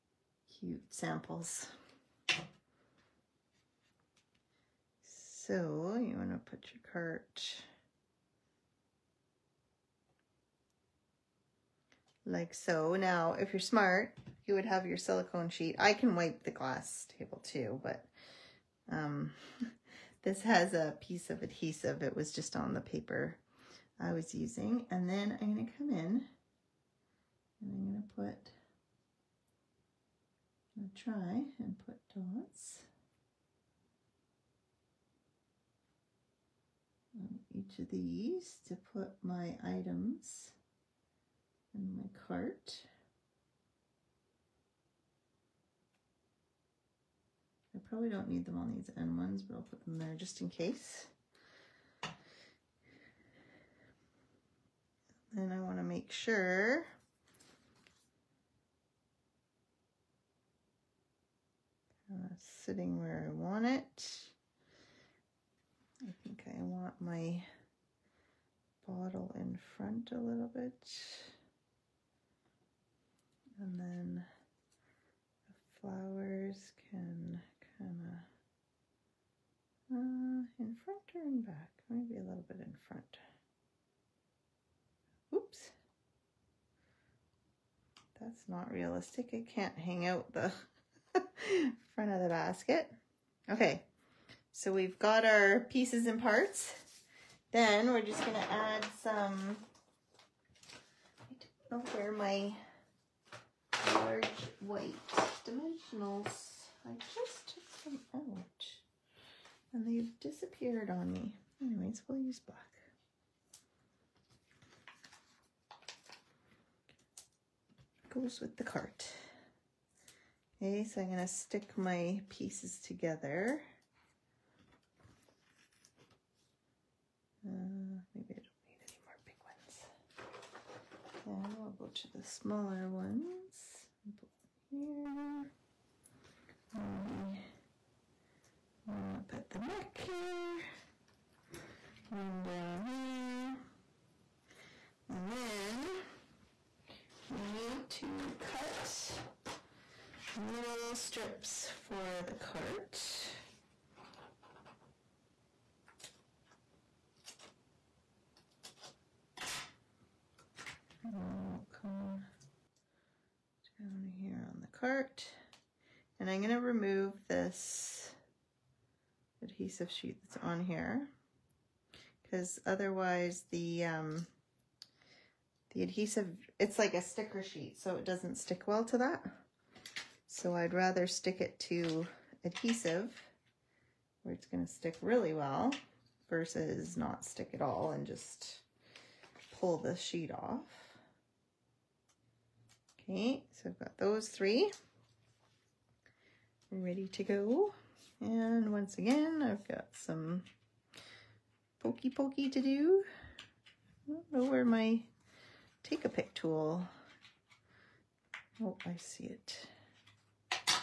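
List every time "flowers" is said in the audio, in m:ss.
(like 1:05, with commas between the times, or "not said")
1:15.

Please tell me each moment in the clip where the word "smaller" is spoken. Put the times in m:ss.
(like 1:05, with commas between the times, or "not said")
2:12.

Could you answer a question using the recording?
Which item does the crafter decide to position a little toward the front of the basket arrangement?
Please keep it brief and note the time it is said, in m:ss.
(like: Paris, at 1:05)
bottle, at 1:08.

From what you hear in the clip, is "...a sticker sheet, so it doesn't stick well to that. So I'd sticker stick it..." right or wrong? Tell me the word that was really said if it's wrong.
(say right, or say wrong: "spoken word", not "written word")
wrong: "rather", not "sticker".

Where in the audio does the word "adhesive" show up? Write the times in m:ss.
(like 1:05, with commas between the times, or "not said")
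0:21, 2:49, 2:55, 3:02.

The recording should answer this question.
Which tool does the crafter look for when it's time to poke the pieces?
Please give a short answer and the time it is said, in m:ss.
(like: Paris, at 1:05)
take a pick tool, at 3:25.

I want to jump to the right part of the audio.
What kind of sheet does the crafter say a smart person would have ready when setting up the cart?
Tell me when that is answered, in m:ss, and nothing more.
0:14.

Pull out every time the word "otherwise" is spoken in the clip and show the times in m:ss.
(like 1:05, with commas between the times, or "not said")
2:52.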